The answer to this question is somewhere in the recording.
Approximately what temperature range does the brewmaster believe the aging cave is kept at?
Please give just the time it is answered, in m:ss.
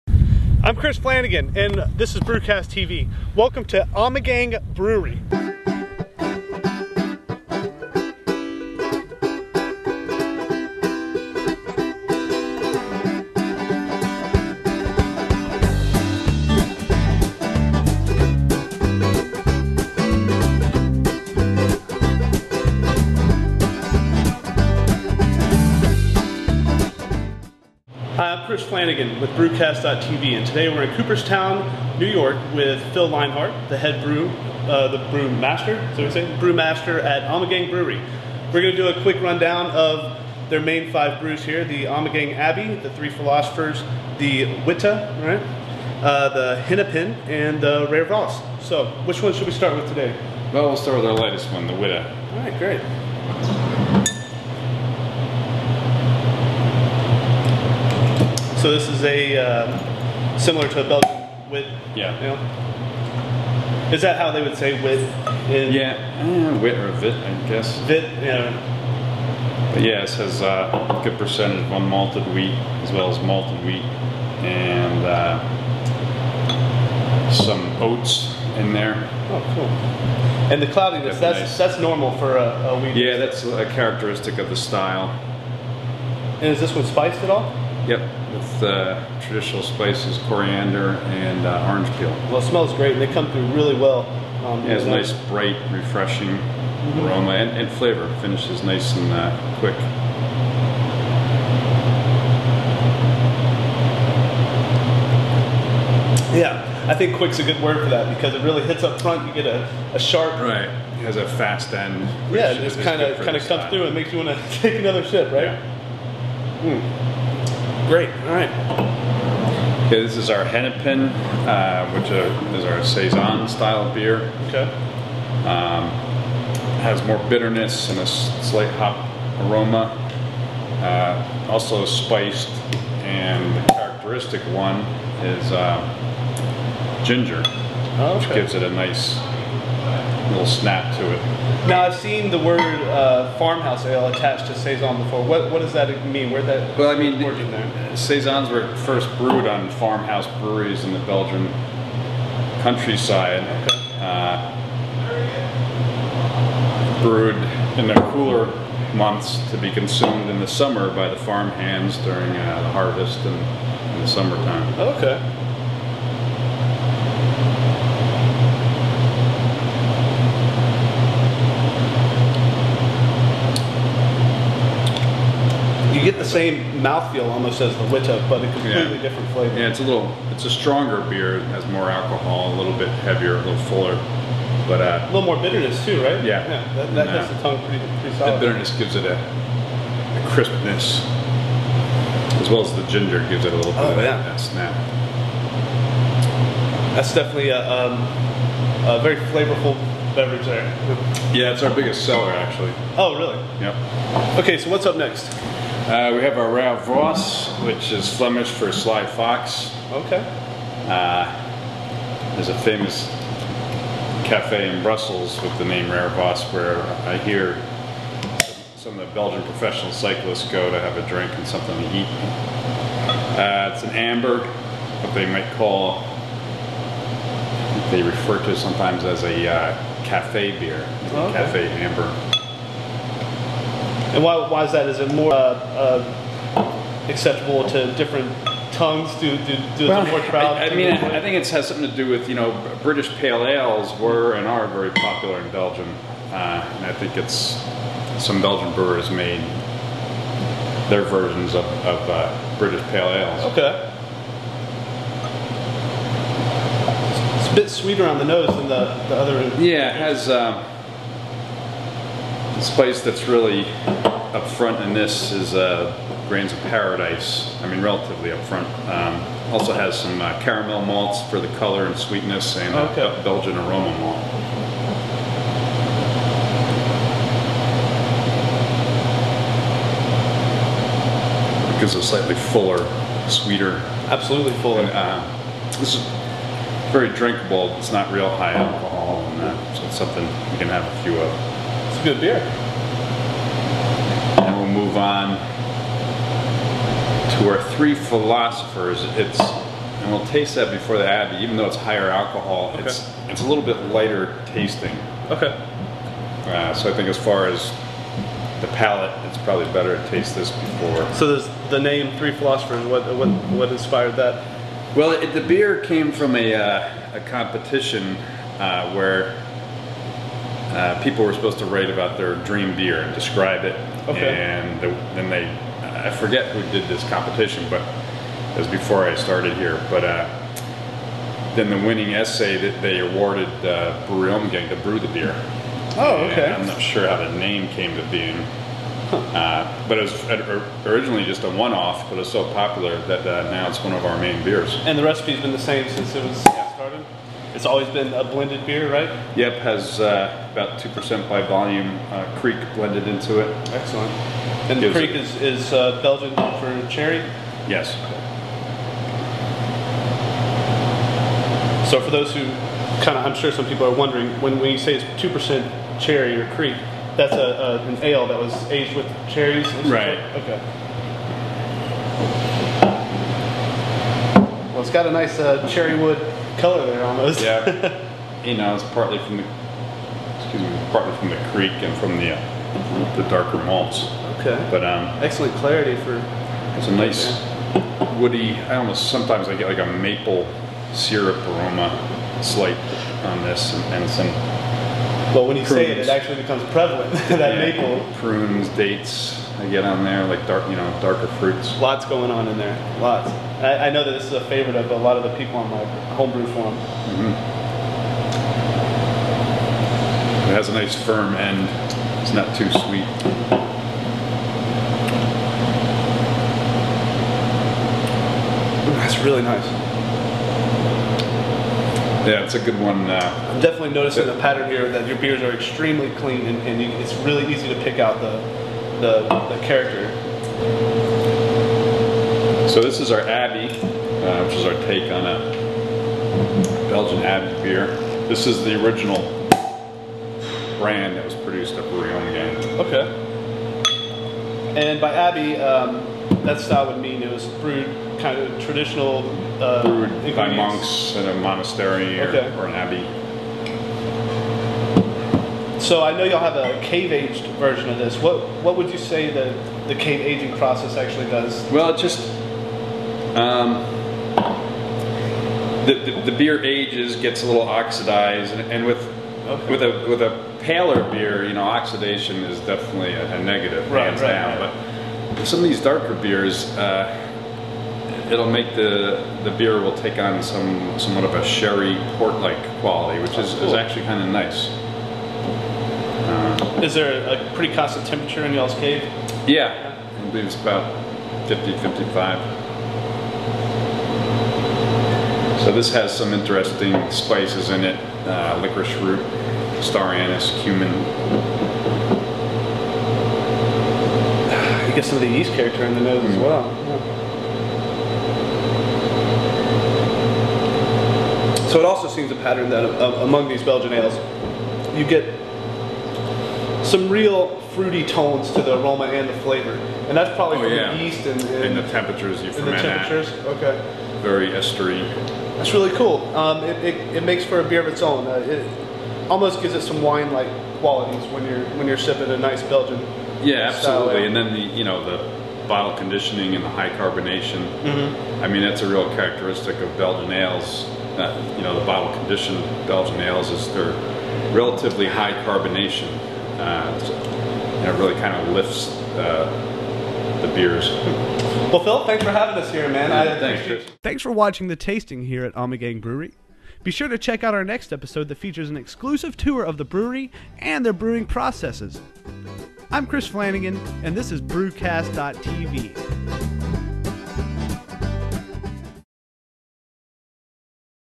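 8:11.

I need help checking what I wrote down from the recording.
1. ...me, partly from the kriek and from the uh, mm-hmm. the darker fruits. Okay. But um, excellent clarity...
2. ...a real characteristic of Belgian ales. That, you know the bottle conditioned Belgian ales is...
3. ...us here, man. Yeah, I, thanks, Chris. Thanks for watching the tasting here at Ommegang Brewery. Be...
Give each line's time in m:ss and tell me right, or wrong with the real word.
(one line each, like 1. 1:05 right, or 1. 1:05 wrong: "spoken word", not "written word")
1. 6:20 wrong: "malts", not "fruits"
2. 8:58 right
3. 9:12 right.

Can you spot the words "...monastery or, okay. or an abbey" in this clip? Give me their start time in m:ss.
7:31.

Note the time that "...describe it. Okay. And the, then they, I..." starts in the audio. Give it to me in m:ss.
5:23.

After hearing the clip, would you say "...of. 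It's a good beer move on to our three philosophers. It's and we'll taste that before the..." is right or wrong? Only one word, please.
right.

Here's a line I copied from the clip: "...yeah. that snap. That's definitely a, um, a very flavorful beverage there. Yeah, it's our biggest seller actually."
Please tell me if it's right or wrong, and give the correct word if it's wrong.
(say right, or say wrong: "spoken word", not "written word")
right.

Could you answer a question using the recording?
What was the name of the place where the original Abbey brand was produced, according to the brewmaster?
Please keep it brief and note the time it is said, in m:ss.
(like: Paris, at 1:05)
Rouillon, at 7:21.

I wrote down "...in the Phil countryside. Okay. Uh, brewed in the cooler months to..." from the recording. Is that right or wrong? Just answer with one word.
wrong.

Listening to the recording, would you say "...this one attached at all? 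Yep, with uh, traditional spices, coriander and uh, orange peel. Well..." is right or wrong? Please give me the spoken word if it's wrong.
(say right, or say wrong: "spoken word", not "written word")
wrong: "spiced", not "attached".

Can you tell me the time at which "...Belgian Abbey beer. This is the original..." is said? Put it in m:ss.
7:16.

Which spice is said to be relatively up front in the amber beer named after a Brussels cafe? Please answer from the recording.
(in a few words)
Grains of paradise.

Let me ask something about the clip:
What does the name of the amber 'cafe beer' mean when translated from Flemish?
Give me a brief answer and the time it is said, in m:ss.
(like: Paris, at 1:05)
Sly Fox, at 3:28.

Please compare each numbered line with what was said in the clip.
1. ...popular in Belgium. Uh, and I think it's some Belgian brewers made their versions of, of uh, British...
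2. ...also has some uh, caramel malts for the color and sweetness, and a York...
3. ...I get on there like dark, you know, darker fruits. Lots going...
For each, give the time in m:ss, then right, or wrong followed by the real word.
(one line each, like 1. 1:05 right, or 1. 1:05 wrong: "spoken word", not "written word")
1. 4:04 right
2. 4:29 wrong: "Belgian", not "York"
3. 6:39 right.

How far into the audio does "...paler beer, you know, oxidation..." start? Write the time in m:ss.
7:50.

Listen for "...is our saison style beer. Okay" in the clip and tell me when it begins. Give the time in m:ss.
2:02.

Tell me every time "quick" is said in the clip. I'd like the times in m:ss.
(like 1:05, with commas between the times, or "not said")
0:39, 1:39, 1:47.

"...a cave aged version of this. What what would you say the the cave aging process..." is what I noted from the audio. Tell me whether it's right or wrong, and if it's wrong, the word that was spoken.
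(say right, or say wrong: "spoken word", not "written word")
right.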